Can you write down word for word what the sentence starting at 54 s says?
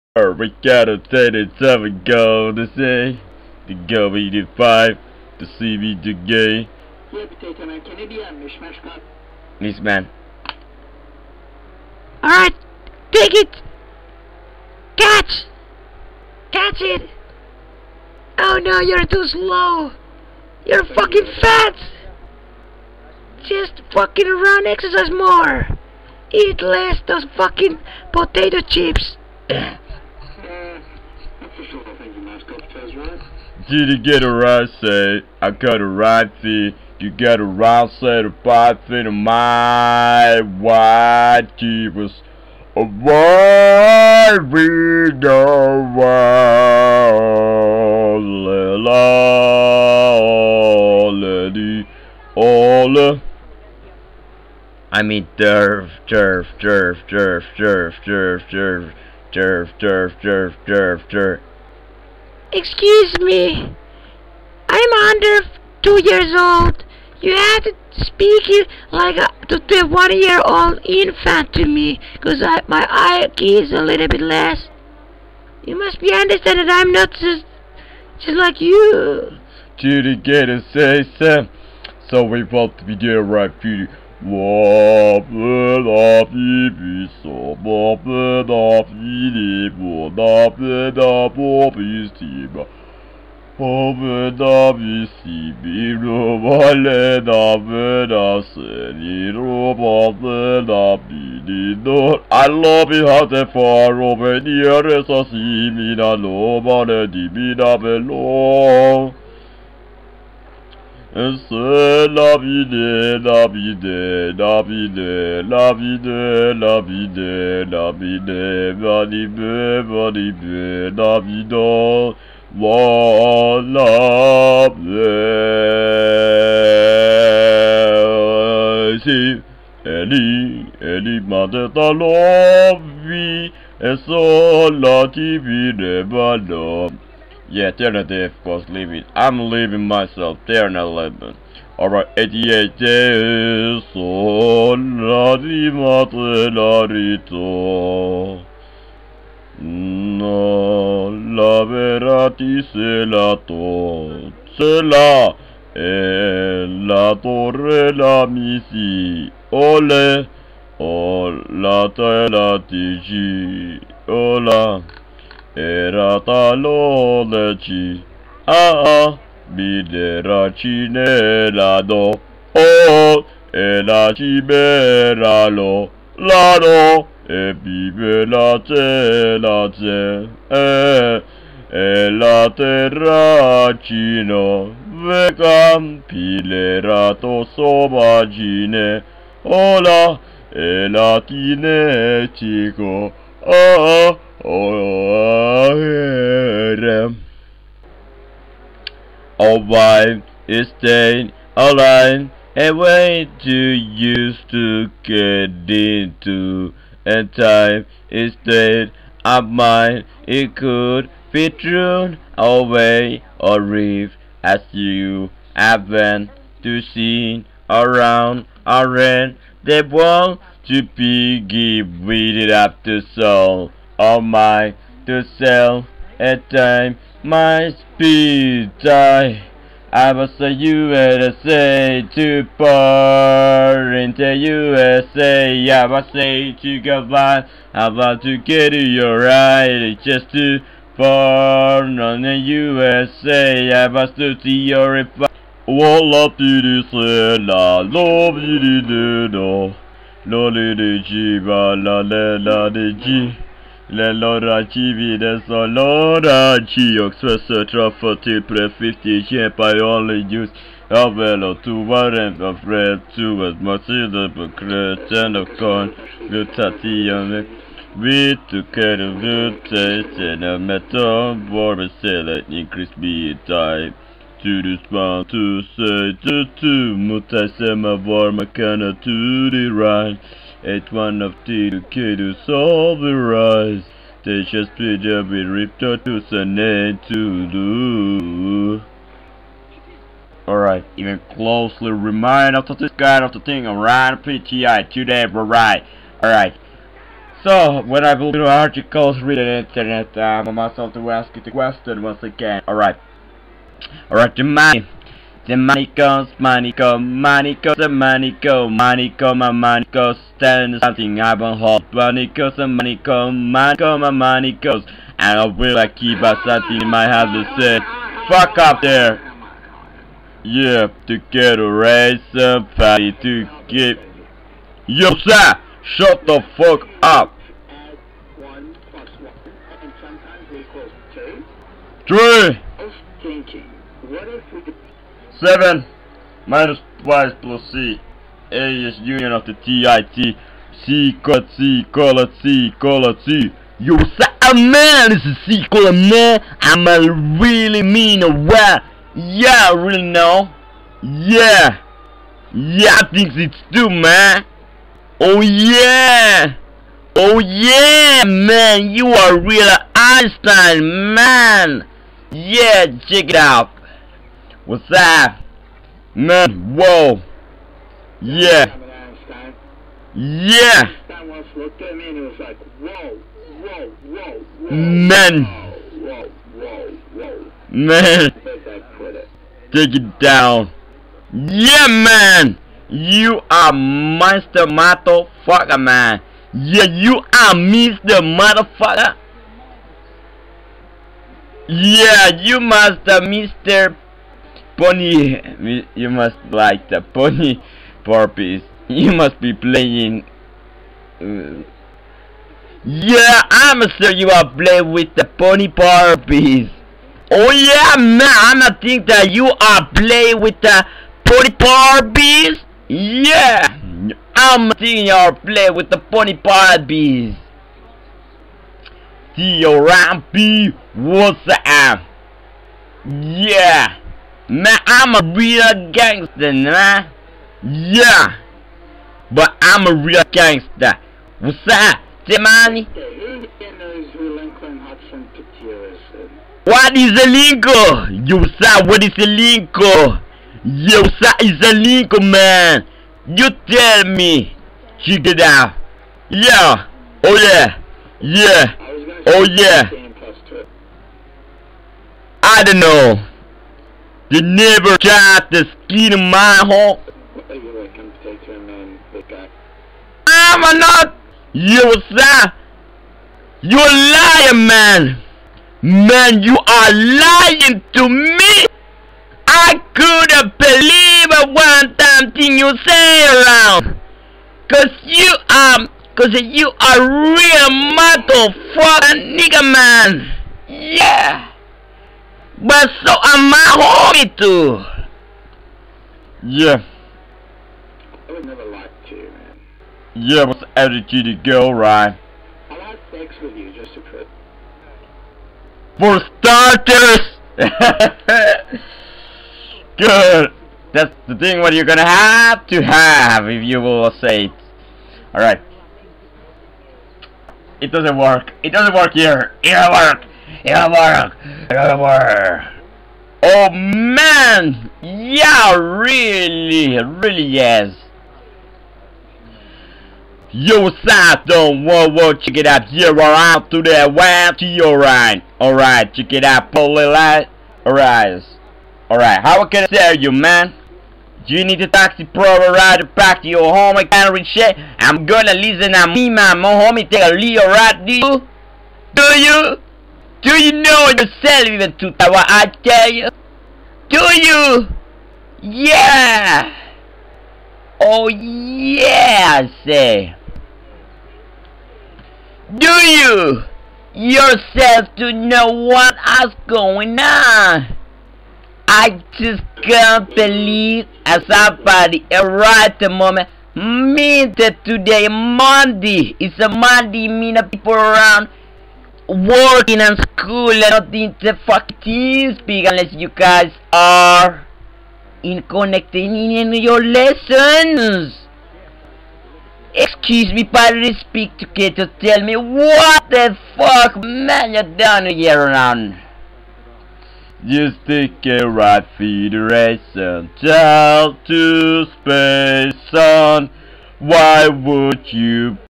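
I mean, derf, derf, derf, derf, derf, derf, derf, derf, derf, derf, derf, derf.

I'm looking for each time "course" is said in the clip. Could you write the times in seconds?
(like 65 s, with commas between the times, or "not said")
138 s.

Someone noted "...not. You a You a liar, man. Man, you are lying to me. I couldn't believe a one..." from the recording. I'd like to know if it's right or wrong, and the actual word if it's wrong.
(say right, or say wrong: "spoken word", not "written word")
right.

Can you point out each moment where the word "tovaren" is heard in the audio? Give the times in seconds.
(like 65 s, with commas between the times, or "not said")
261 s.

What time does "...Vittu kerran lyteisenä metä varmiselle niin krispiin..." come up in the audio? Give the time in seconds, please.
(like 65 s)
268 s.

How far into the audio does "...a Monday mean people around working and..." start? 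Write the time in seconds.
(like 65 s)
566 s.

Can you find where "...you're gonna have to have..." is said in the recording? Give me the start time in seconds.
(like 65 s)
501 s.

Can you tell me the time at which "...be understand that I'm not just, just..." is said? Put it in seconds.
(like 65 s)
76 s.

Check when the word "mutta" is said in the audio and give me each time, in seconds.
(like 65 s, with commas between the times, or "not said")
276 s.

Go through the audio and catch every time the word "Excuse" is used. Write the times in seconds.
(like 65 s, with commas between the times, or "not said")
62 s, 579 s.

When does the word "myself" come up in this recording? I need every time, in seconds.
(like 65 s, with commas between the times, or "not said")
139 s, 300 s.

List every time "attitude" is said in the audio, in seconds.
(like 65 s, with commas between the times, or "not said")
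490 s.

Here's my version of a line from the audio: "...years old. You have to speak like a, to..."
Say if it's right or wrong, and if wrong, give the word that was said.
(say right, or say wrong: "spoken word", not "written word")
right.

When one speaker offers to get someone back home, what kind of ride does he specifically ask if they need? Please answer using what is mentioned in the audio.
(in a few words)
taxi.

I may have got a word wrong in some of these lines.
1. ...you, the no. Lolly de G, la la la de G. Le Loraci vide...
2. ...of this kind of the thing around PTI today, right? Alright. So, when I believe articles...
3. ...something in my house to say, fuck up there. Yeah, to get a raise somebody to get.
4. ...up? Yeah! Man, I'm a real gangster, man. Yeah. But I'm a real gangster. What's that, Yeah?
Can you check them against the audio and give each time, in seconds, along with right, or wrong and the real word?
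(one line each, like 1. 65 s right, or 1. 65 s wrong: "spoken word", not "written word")
1. 248 s right
2. 292 s right
3. 316 s right
4. 421 s wrong: "Timani", not "Yeah".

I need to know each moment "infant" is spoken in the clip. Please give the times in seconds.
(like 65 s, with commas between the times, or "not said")
70 s.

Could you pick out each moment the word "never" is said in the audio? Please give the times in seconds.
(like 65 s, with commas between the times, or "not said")
454 s, 488 s.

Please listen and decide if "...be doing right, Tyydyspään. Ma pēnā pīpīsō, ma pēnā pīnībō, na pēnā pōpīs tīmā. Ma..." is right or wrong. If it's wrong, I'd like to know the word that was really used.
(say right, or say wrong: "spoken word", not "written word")
wrong: "Judy", not "Tyydyspään".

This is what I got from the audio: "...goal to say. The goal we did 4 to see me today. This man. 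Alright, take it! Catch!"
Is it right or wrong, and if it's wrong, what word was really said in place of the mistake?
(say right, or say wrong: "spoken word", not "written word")
wrong: "5", not "4".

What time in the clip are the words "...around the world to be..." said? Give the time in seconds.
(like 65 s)
218 s.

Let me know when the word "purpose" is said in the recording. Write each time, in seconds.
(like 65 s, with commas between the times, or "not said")
398 s, 405 s, 411 s.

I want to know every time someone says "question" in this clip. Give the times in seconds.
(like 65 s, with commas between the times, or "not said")
301 s.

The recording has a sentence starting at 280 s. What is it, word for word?
It's one of the key to solve the rise.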